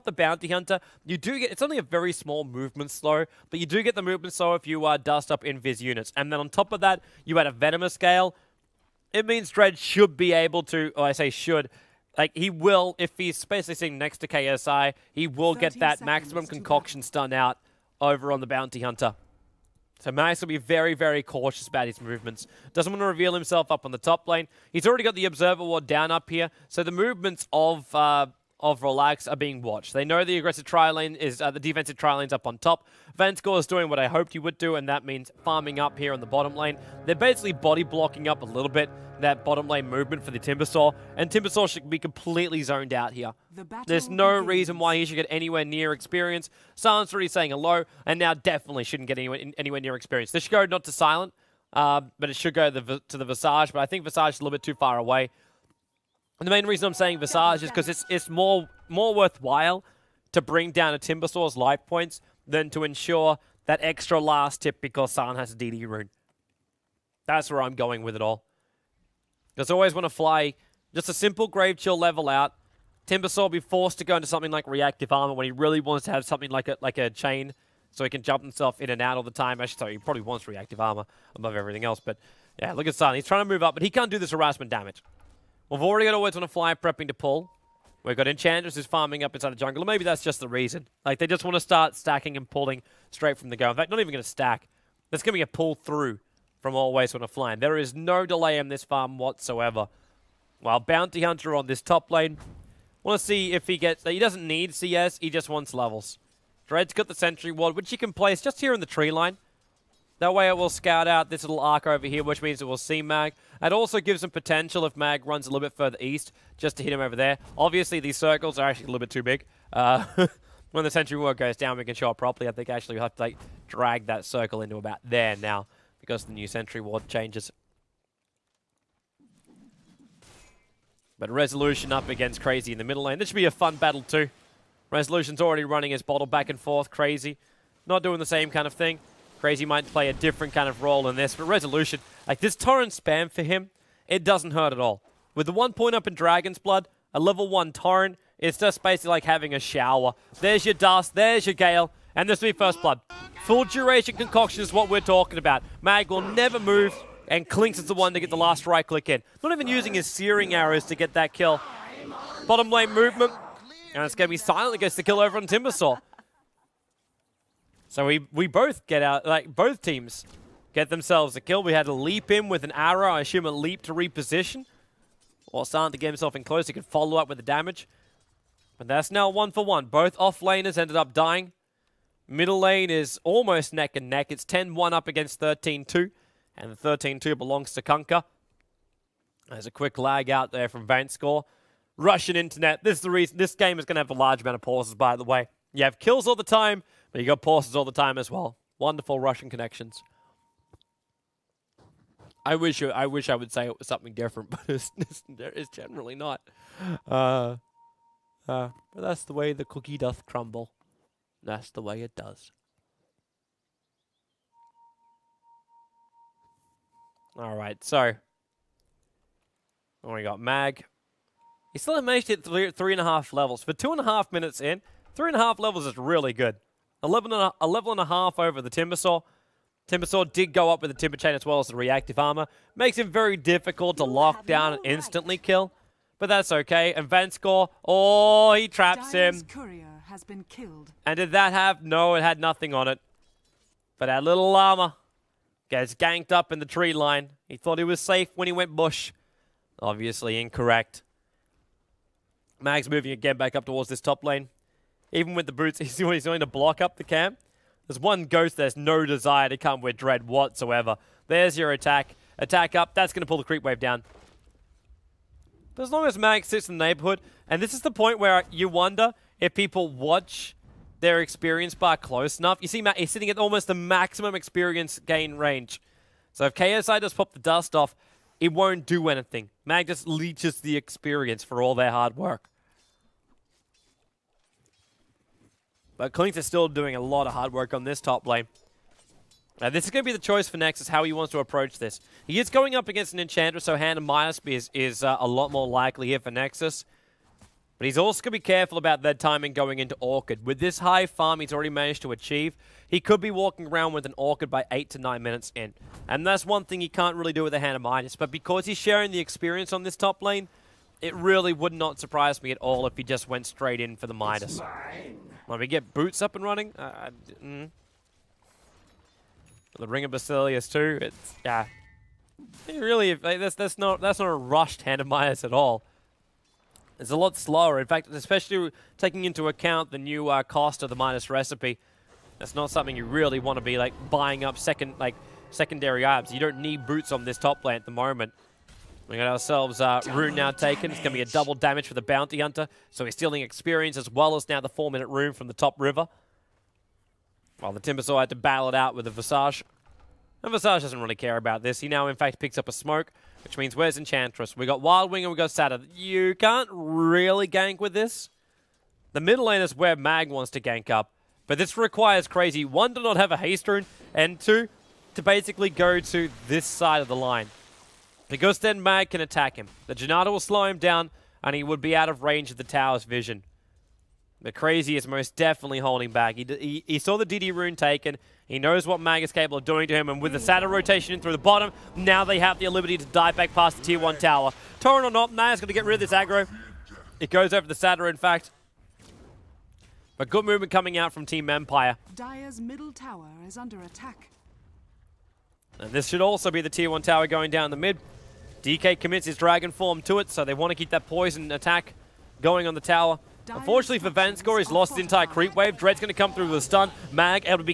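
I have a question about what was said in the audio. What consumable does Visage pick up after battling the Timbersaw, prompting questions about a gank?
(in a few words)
Smoke.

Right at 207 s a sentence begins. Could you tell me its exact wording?
Uh, uh, but that's the way the cookie doth crumble.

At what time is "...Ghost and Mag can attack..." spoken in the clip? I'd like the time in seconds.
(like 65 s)
368 s.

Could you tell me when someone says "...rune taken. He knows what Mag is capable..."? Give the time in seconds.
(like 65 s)
377 s.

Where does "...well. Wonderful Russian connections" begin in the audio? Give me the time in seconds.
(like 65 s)
198 s.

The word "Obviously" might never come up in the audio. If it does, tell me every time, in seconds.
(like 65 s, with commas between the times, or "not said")
117 s, 249 s.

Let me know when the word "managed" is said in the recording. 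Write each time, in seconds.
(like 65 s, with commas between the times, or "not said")
222 s, 301 s.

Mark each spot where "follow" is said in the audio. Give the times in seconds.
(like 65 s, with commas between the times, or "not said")
176 s.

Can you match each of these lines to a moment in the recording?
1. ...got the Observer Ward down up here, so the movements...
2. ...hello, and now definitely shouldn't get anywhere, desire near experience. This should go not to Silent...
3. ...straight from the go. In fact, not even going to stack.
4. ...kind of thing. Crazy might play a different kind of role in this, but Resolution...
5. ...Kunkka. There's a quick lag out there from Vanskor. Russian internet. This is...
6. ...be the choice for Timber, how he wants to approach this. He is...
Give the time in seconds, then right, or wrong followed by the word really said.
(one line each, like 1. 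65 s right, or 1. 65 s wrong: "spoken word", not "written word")
1. 25 s right
2. 47 s wrong: "anywhere", not "desire"
3. 93 s right
4. 138 s right
5. 187 s right
6. 290 s wrong: "Nexus", not "Timber".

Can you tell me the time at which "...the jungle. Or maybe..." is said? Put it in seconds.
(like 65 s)
89 s.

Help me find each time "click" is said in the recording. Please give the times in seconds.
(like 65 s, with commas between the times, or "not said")
158 s.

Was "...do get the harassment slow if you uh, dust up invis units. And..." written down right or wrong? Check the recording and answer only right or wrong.
wrong.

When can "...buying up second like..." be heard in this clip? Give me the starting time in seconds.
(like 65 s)
334 s.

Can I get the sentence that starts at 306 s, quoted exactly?
And that's one thing he can't really do with a Hand of Midas.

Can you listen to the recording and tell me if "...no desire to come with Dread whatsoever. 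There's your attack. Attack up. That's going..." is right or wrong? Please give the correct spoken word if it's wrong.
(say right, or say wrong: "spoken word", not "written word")
right.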